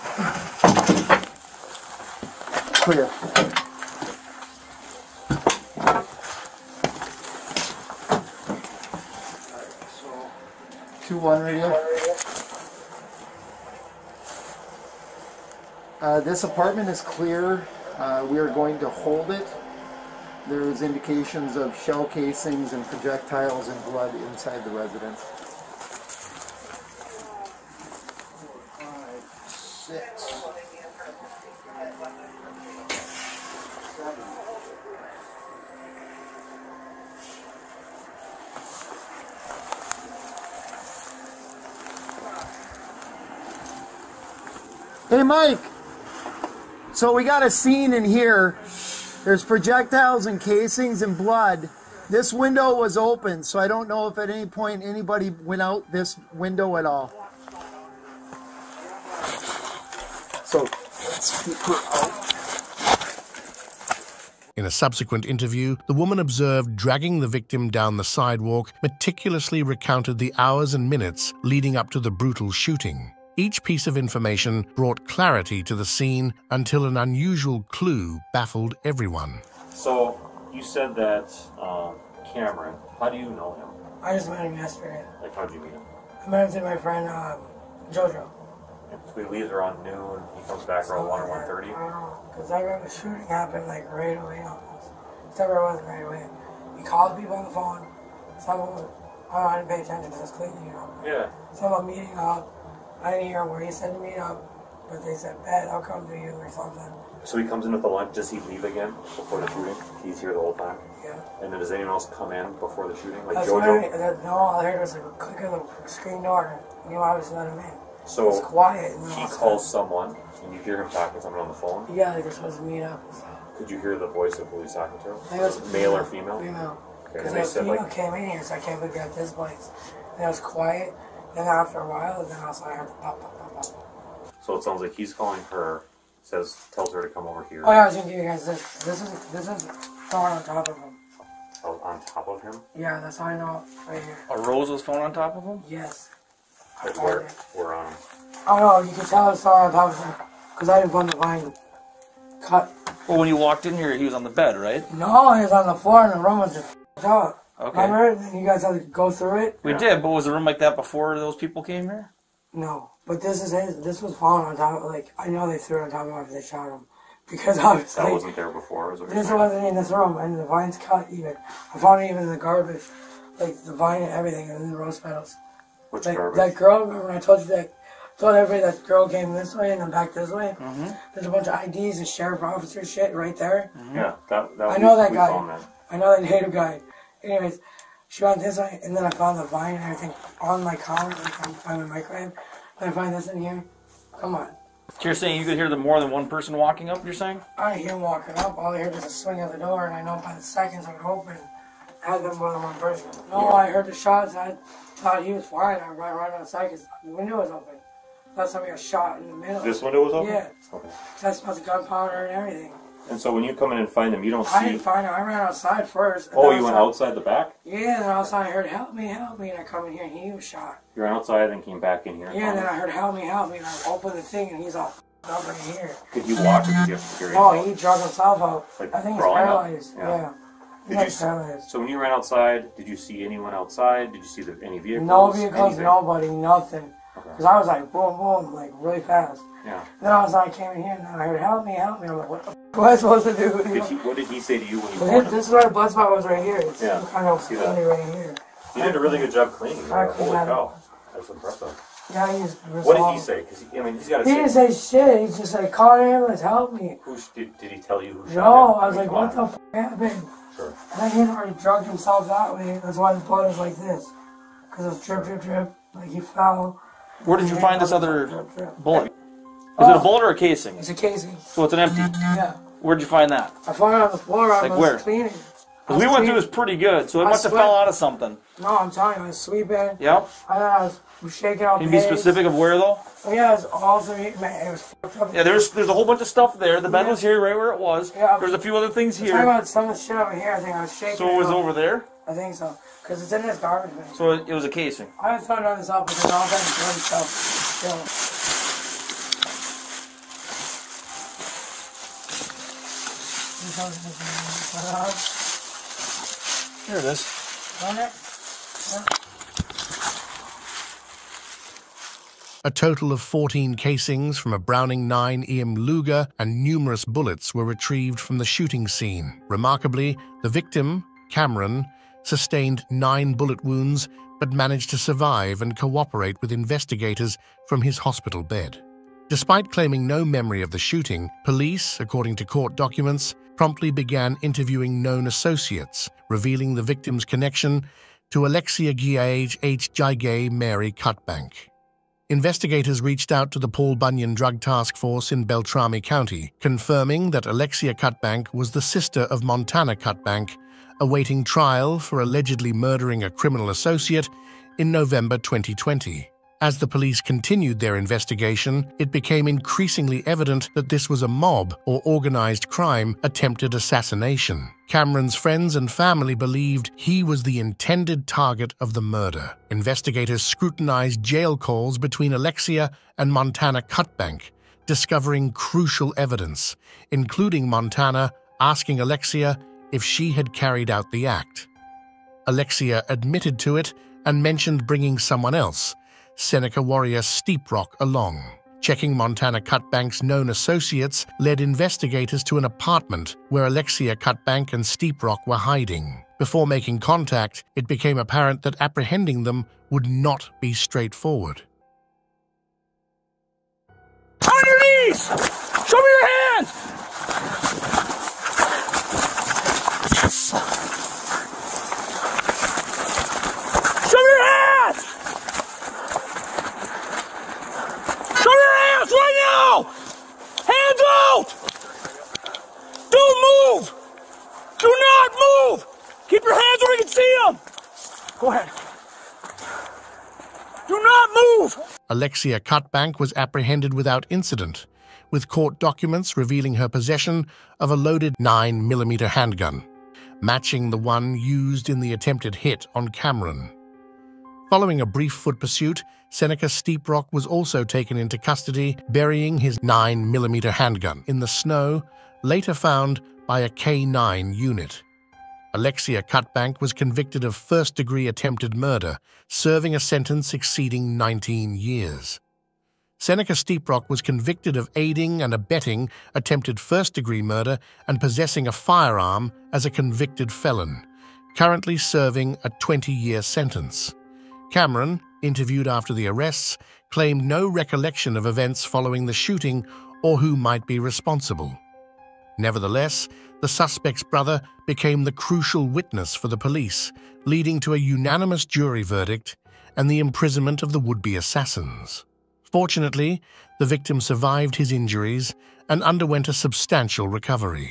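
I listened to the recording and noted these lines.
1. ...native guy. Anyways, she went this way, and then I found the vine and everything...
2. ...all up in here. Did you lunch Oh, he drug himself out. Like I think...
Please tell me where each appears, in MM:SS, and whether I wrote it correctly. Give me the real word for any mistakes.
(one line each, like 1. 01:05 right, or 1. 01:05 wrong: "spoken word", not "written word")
1. 03:06 right
2. 03:44 wrong: "watch", not "lunch".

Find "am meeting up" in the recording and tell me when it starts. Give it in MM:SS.
01:41.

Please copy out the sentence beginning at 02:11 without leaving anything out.
Then after a while, and then I was like, pop, pop, pop, pop.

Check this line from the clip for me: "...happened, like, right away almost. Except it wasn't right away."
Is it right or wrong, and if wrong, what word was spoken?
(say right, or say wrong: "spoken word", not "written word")
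right.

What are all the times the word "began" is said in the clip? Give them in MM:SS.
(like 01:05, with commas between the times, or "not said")
05:33.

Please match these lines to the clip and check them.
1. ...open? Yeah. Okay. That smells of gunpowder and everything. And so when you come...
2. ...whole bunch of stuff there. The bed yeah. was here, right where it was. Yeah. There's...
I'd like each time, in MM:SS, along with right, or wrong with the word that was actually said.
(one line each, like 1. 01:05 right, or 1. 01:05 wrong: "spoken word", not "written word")
1. 03:30 right
2. 04:45 right.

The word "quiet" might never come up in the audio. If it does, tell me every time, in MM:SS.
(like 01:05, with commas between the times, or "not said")
01:58, 02:10.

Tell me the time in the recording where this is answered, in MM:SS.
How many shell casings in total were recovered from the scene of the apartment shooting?
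05:13.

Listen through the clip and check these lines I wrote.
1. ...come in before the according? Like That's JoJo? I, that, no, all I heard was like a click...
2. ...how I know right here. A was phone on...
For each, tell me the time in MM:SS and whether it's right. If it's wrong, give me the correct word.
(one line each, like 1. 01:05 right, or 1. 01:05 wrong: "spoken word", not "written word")
1. 01:52 wrong: "shooting", not "according"
2. 02:23 right.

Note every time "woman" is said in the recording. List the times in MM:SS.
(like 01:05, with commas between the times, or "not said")
01:05.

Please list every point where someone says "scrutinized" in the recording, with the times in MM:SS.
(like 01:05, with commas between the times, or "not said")
06:10.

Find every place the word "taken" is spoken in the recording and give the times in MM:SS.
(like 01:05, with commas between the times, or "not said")
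07:27.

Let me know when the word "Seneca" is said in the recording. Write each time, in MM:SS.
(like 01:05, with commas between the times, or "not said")
06:26, 07:26, 07:43.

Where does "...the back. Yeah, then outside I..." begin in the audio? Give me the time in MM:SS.
03:37.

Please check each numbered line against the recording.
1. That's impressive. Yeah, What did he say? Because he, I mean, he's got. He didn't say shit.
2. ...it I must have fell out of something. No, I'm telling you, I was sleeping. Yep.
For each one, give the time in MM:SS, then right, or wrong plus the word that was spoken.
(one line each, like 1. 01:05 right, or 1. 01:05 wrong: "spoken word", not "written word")
1. 04:11 right
2. 04:37 right.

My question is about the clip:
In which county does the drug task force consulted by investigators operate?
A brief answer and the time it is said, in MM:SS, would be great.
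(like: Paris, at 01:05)
Beltrami County, at 05:45.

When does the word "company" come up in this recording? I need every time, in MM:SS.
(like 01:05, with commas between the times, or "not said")
not said.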